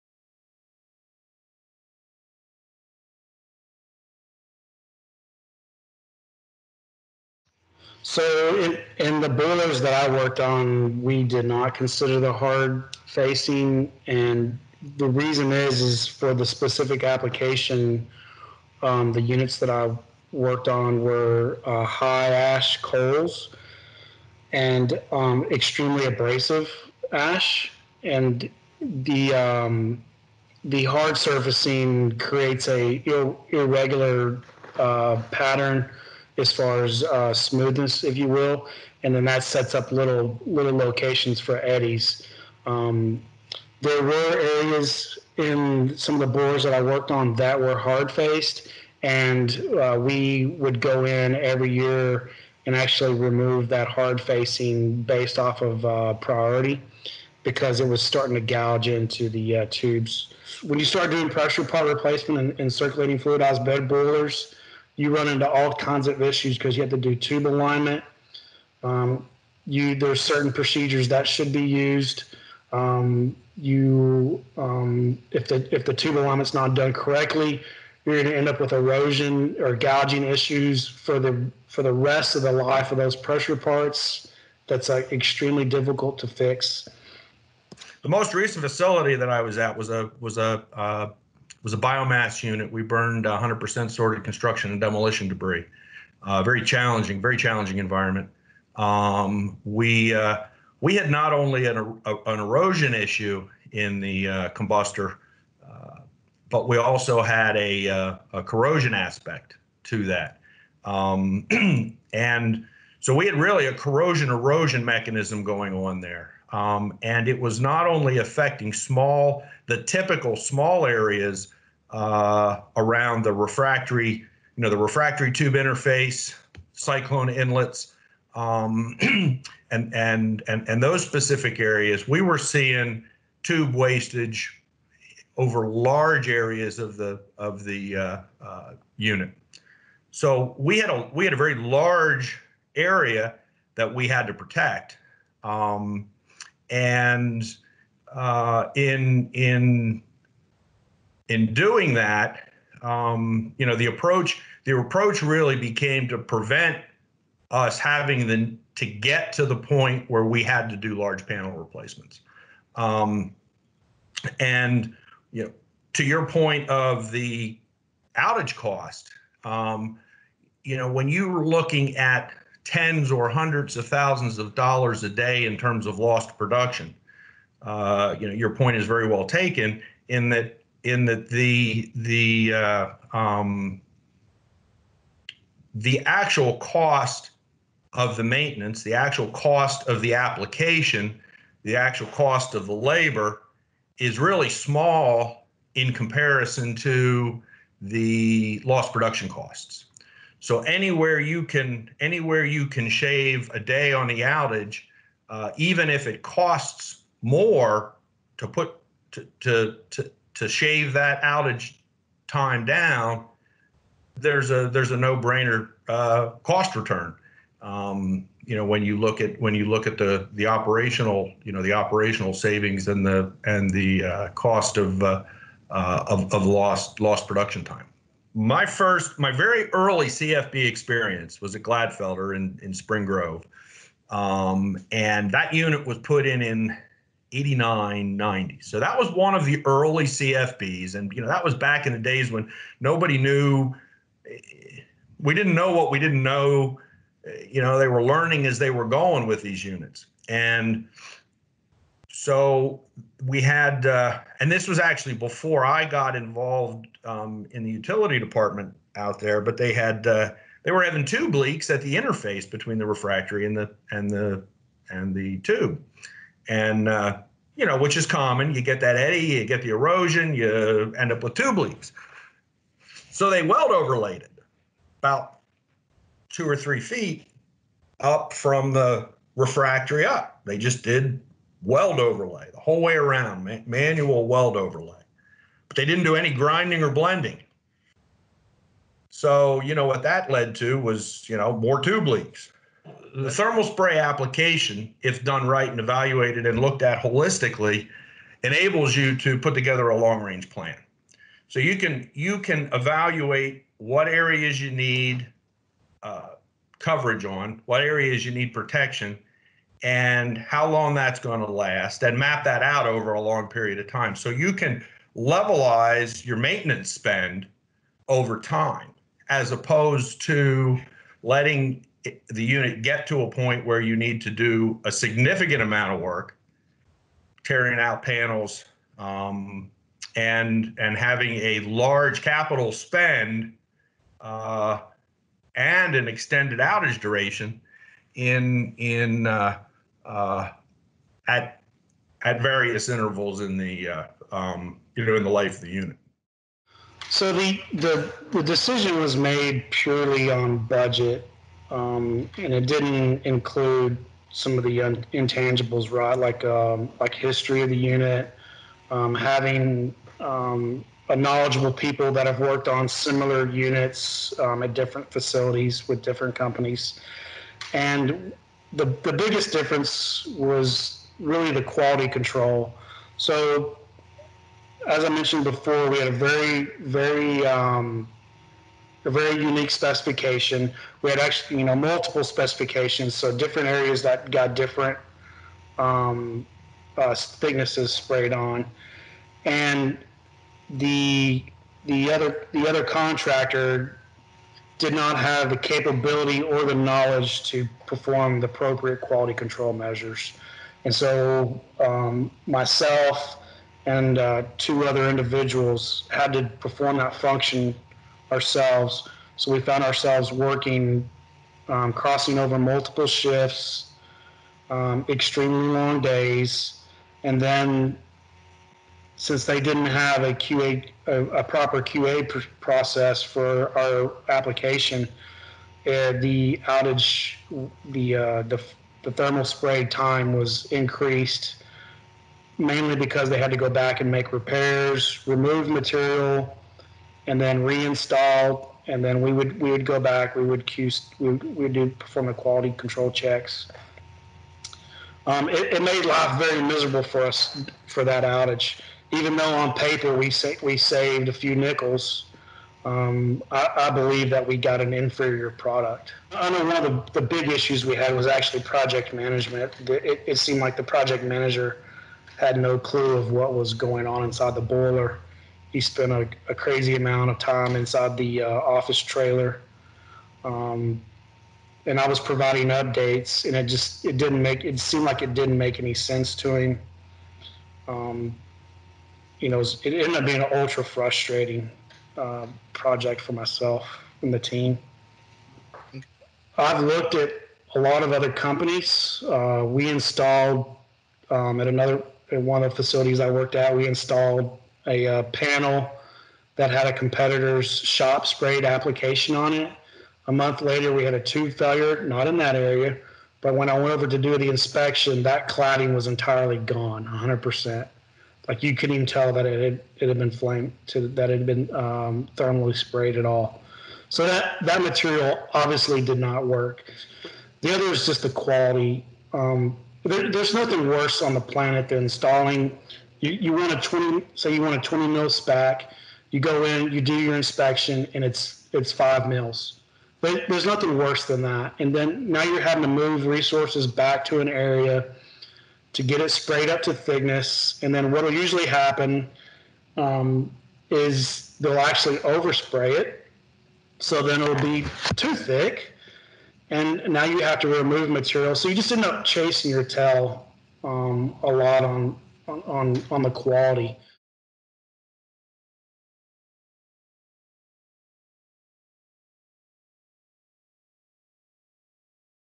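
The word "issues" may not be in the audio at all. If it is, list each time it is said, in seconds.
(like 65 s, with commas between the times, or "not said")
66 s, 80 s, 102 s, 457 s.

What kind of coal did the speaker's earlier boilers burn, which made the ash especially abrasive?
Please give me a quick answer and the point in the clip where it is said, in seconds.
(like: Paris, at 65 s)
High ash coals, at 21 s.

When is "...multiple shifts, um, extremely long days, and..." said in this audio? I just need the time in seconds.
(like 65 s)
412 s.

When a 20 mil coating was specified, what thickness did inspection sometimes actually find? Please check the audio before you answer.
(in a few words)
5 mils.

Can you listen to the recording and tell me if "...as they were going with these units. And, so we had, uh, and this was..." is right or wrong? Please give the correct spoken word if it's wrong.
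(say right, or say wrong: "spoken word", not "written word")
right.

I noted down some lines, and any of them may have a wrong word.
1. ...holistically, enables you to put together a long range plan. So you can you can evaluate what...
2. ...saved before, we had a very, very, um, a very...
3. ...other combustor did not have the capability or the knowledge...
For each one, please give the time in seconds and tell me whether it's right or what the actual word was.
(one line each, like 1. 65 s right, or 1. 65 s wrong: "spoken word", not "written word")
1. 297 s right
2. 375 s wrong: "mentioned", not "saved"
3. 392 s wrong: "contractor", not "combustor".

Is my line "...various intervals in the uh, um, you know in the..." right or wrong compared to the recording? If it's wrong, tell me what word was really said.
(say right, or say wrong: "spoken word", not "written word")
right.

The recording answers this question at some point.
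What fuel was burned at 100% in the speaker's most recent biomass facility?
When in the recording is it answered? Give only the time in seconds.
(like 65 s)
93 s.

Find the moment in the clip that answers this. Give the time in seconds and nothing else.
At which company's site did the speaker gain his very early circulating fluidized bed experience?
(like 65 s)
231 s.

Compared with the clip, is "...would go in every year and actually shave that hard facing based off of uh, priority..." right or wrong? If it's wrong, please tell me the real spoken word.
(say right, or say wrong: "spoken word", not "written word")
wrong: "remove", not "shave".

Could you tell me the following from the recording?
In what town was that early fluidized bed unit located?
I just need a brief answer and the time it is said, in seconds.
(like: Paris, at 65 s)
Spring Grove, at 232 s.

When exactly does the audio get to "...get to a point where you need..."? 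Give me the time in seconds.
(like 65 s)
322 s.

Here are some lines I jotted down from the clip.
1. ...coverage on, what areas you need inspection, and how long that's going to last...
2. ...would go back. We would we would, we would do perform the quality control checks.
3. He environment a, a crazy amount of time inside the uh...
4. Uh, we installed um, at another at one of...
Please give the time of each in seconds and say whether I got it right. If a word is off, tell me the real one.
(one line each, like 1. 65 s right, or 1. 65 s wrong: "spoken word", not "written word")
1. 306 s wrong: "protection", not "inspection"
2. 439 s right
3. 465 s wrong: "spent", not "environment"
4. 489 s right.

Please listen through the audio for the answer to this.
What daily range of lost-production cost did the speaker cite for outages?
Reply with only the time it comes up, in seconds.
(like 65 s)
172 s.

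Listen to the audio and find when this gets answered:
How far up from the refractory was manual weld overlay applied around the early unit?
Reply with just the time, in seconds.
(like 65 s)
276 s.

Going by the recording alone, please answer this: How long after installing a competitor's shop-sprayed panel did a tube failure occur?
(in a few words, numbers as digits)
A month.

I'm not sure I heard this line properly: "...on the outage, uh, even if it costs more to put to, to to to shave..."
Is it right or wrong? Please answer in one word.
right.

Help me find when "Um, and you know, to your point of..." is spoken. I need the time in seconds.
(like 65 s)
162 s.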